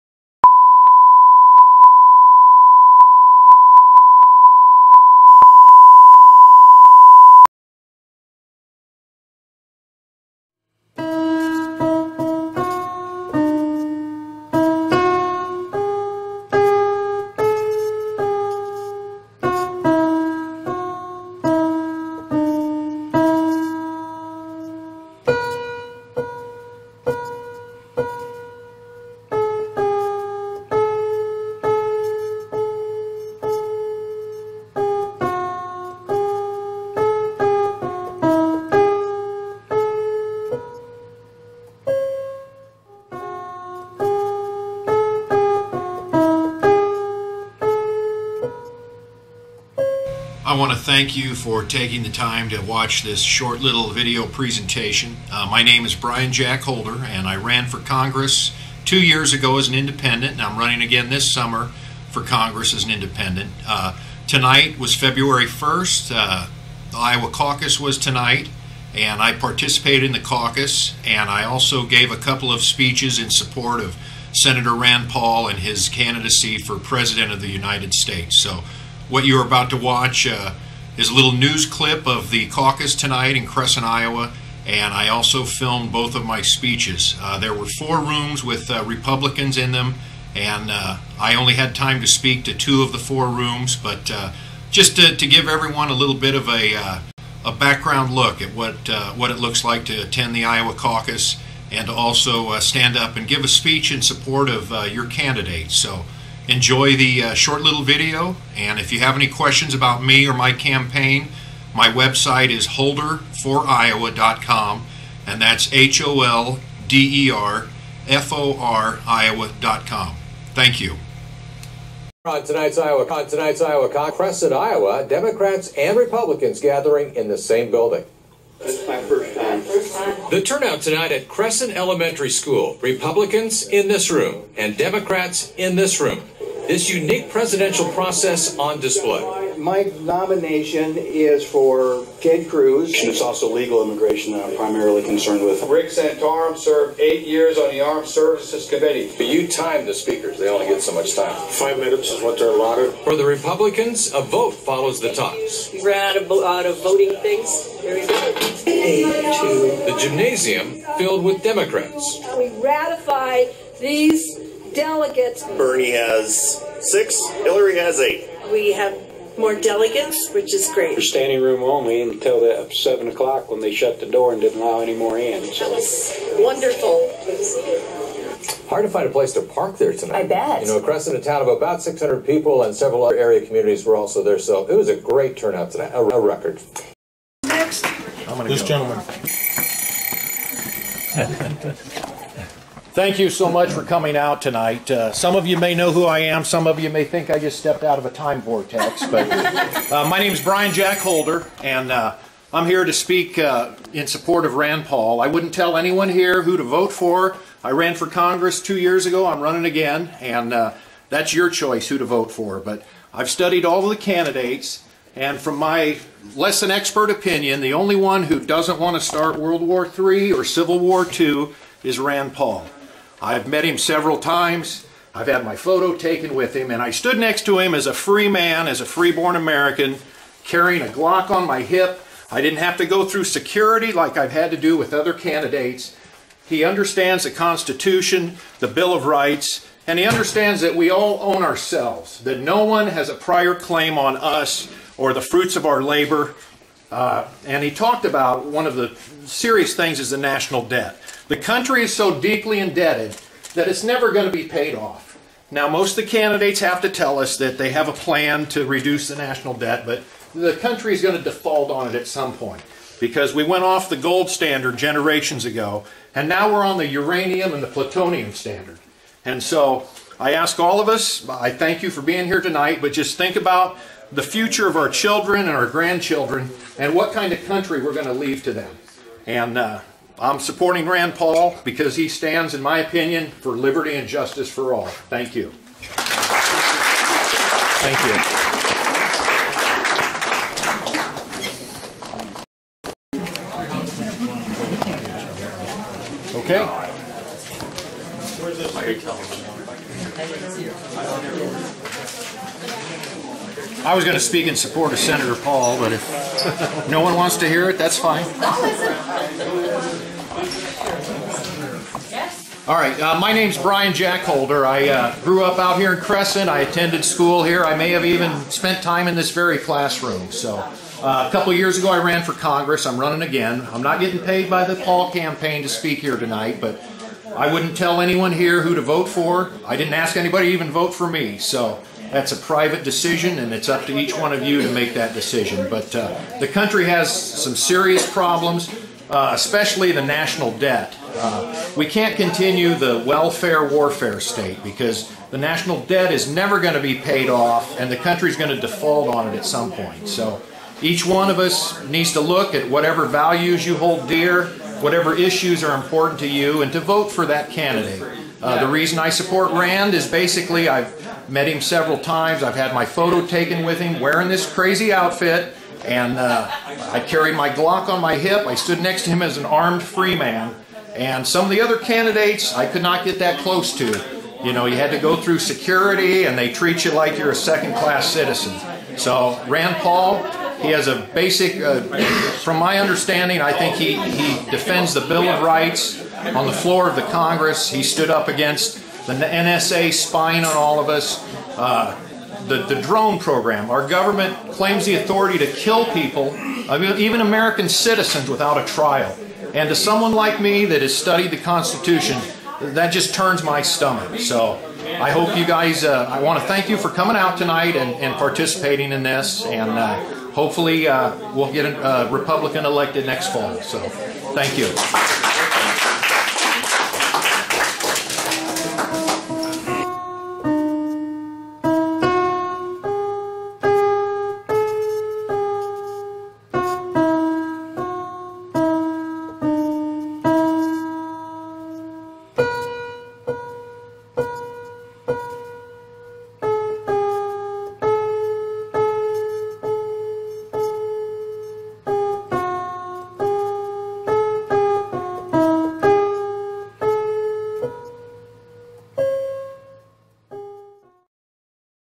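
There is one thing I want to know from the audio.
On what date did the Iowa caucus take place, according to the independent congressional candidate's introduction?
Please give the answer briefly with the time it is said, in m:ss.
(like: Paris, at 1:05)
February 1st, at 1:04.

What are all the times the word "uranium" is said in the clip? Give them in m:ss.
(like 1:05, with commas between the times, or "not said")
4:26.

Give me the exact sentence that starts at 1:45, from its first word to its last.
So enjoy the uh, short little video.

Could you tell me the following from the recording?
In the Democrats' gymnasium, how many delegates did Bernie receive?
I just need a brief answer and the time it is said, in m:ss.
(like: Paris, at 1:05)
6, at 2:45.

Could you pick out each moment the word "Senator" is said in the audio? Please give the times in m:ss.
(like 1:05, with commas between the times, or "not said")
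1:14, 5:04.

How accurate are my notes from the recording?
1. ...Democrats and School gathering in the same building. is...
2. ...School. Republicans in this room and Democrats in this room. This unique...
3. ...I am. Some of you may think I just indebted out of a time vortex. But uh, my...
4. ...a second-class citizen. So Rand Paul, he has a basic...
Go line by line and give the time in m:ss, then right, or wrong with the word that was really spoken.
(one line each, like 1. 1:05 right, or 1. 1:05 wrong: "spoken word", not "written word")
1. 2:05 wrong: "Republicans", not "School"
2. 2:12 right
3. 3:16 wrong: "stepped", not "indebted"
4. 6:17 right.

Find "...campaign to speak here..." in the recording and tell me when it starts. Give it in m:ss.
5:25.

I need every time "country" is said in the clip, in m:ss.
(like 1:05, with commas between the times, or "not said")
4:11, 4:20, 4:37, 5:36, 5:47.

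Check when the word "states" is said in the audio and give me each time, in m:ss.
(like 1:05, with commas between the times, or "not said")
1:17, 5:44.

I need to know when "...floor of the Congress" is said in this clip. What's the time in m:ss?
6:26.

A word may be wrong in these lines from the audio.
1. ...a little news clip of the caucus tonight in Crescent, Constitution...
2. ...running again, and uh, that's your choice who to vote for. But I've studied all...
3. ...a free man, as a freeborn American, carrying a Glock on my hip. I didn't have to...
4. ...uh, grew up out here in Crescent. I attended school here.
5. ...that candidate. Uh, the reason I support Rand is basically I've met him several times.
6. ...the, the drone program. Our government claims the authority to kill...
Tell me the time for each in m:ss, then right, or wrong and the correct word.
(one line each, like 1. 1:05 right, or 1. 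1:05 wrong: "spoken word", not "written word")
1. 1:21 wrong: "Iowa", not "Constitution"
2. 3:29 right
3. 3:47 right
4. 5:14 right
5. 5:57 right
6. 6:32 right.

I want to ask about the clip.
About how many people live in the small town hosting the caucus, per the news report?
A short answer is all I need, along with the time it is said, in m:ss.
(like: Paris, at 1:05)
600, at 3:01.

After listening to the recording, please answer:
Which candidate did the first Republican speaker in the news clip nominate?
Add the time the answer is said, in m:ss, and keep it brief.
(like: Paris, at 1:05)
Ted Cruz, at 2:22.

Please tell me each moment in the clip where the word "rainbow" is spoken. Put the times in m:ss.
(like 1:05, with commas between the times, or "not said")
not said.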